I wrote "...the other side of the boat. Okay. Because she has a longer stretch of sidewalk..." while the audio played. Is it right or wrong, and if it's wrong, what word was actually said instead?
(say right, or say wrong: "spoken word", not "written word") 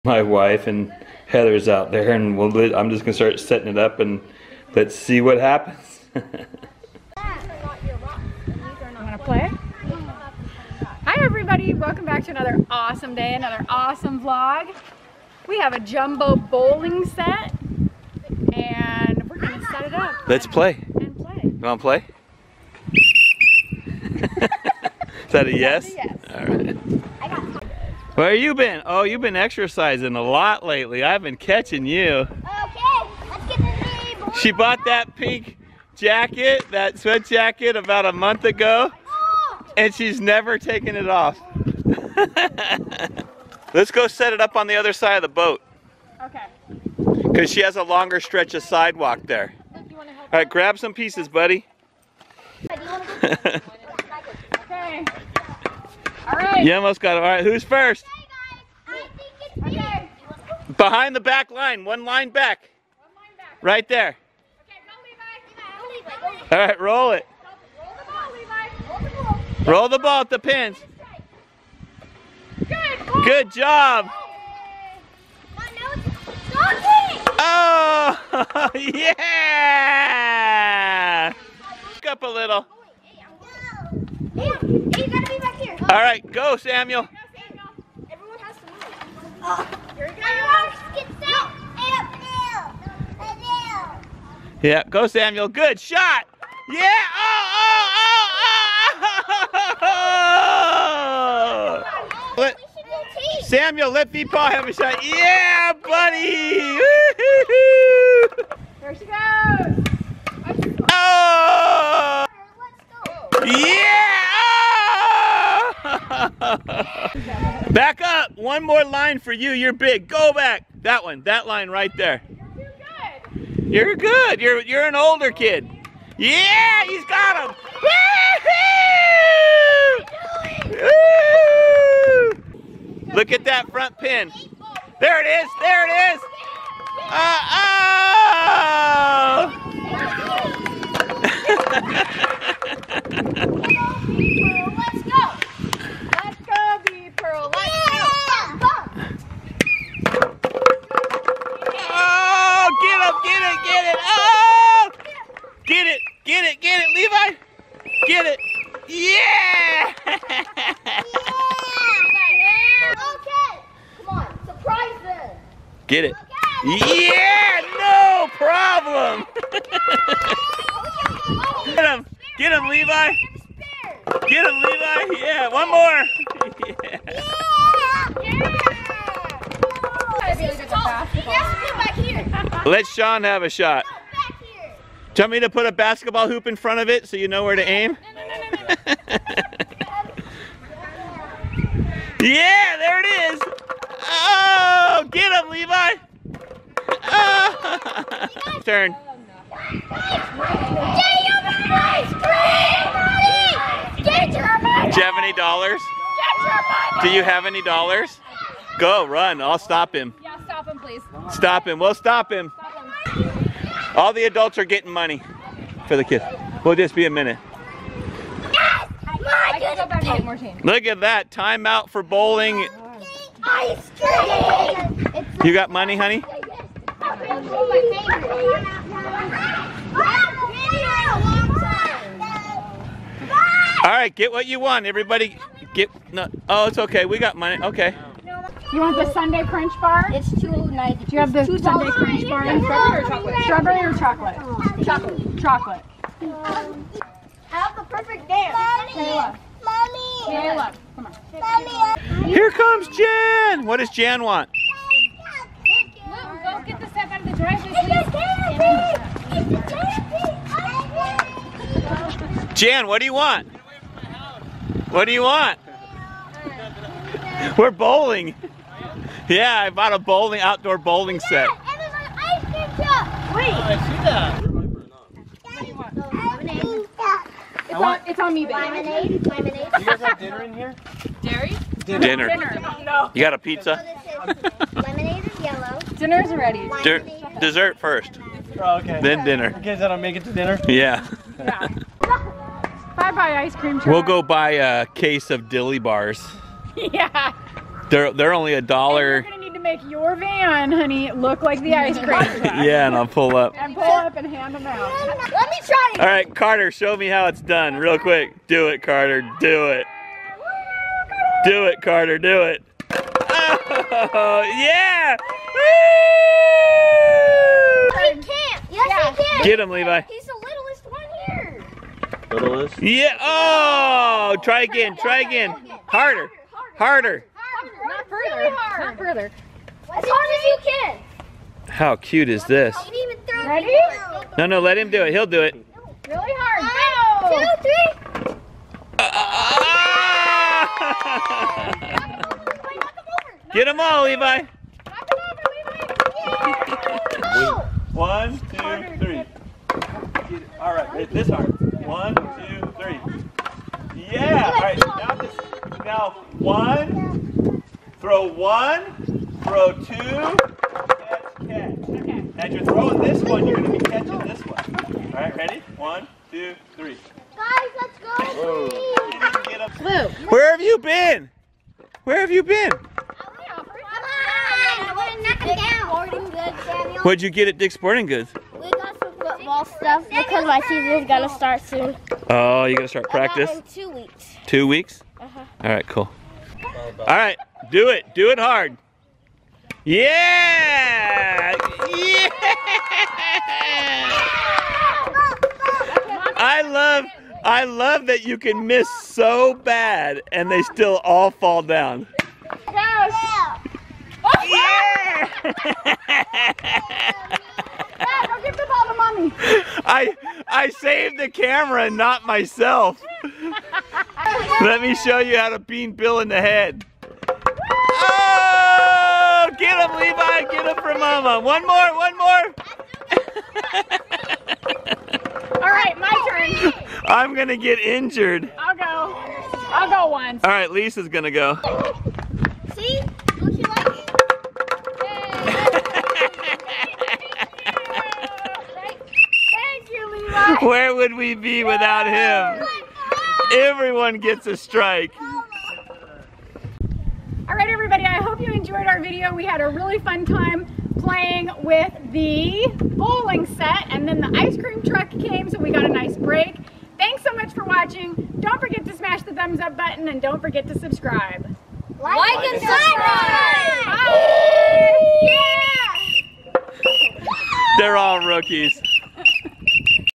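right.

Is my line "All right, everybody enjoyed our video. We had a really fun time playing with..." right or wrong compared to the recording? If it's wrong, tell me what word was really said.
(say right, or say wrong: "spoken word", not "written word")
right.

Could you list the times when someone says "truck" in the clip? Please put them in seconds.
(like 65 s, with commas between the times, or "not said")
293 s, 302 s, 454 s.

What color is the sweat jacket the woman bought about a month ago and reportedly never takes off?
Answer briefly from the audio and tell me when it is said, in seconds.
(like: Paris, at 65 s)
Pink, at 35 s.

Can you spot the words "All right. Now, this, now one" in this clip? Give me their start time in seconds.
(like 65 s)
354 s.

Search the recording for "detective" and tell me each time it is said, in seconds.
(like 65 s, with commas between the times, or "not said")
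not said.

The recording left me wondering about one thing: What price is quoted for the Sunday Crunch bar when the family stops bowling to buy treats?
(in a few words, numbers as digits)
$2.90.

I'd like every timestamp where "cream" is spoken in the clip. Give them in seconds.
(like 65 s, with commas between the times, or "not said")
223 s, 293 s, 301 s, 454 s.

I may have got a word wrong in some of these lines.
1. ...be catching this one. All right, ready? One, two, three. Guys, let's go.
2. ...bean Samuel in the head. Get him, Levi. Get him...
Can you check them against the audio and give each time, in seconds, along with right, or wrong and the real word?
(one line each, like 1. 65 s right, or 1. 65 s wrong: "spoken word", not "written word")
1. 363 s right
2. 415 s wrong: "Bill", not "Samuel".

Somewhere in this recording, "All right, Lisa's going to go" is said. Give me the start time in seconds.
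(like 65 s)
430 s.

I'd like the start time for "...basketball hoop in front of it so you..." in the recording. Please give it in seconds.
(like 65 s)
185 s.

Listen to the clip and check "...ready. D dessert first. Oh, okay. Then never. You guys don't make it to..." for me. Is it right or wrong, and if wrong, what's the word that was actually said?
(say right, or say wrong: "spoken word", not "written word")
wrong: "dinner", not "never".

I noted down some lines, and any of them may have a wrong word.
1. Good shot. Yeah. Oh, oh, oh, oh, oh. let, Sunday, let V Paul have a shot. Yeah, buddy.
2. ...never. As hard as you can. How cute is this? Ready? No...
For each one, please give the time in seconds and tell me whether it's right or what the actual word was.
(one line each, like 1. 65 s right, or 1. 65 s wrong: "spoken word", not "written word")
1. 95 s wrong: "Samuel", not "Sunday"
2. 328 s wrong: "further", not "never".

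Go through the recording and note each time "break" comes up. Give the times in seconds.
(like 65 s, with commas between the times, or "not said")
456 s.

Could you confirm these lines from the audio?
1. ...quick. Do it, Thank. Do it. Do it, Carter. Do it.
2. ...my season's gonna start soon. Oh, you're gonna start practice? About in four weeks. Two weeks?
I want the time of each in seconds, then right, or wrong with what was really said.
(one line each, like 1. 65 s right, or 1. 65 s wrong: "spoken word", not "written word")
1. 307 s wrong: "Carter", not "Thank"
2. 380 s wrong: "two", not "four".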